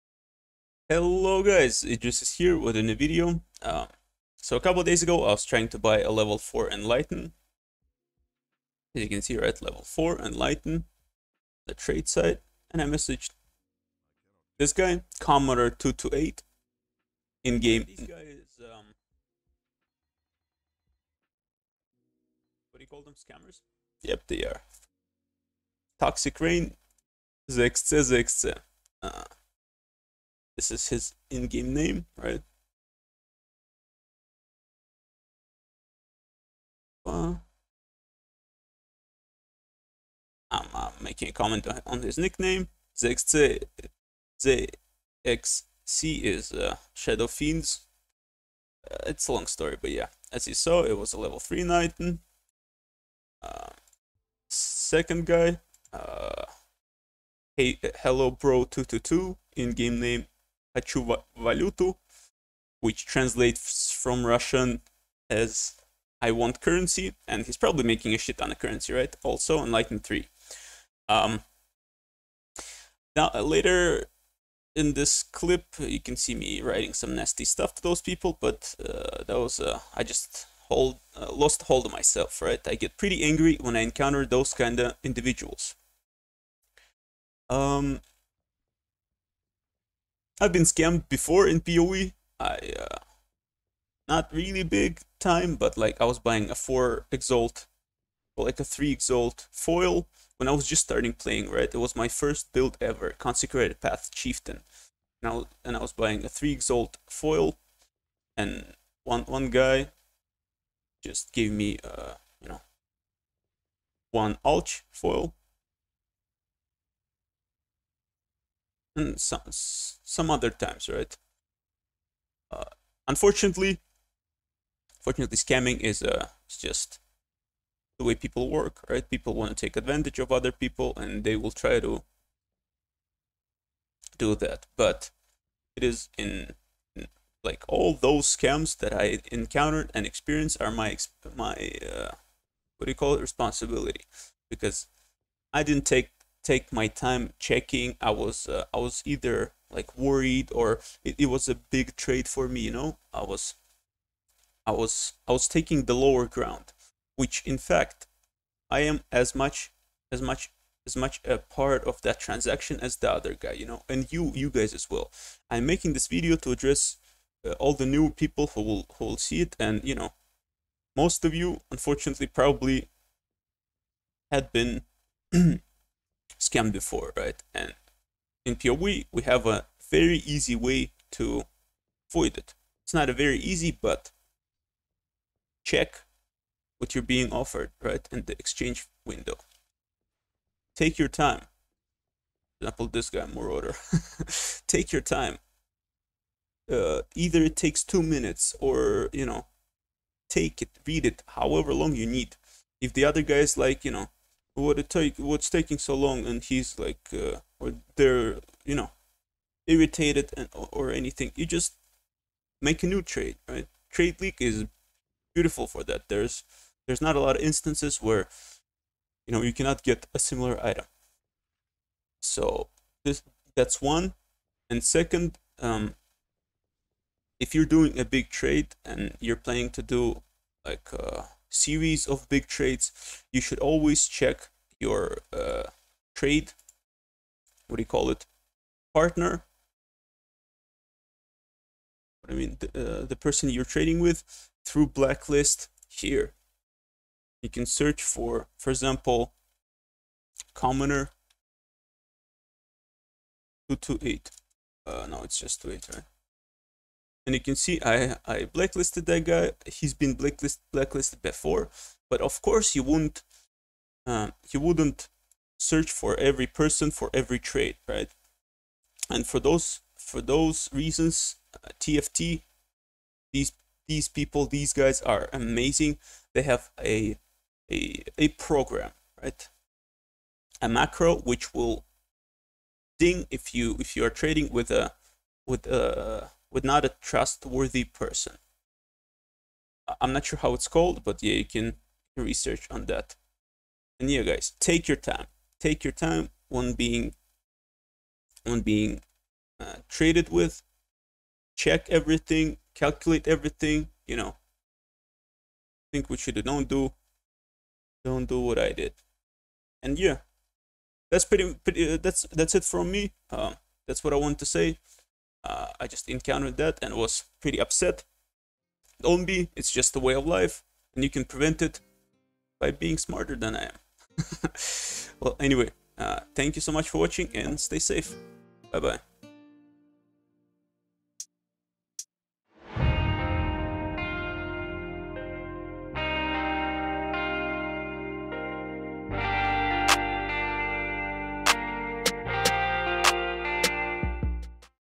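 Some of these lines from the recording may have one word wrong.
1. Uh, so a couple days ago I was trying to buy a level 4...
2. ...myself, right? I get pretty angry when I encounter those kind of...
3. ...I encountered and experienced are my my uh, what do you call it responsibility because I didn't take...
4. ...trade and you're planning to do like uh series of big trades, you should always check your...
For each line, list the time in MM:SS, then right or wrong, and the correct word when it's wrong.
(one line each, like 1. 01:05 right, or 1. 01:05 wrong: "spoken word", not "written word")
1. 00:03 right
2. 01:21 right
3. 02:18 right
4. 03:48 right.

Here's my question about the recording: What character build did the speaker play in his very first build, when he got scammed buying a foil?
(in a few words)
Consecrated Path Chieftain.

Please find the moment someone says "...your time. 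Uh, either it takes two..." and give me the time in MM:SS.
03:14.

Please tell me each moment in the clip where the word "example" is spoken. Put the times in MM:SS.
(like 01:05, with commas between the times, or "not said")
03:12, 04:08.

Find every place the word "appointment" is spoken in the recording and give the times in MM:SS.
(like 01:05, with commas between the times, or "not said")
not said.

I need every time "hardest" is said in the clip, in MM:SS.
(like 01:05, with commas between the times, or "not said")
not said.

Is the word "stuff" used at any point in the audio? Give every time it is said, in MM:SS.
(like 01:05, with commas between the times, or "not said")
01:17.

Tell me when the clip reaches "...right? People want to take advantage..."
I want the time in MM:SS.
02:08.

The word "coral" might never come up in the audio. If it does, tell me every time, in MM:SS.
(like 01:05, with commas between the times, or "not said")
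not said.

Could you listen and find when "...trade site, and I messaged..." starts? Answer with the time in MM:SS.
00:11.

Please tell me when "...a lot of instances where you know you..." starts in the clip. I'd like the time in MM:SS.
03:37.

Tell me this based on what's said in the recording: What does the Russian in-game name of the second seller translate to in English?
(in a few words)
I want currency.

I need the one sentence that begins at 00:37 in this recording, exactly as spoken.
Uh, I'm uh, making a comment on his nickname.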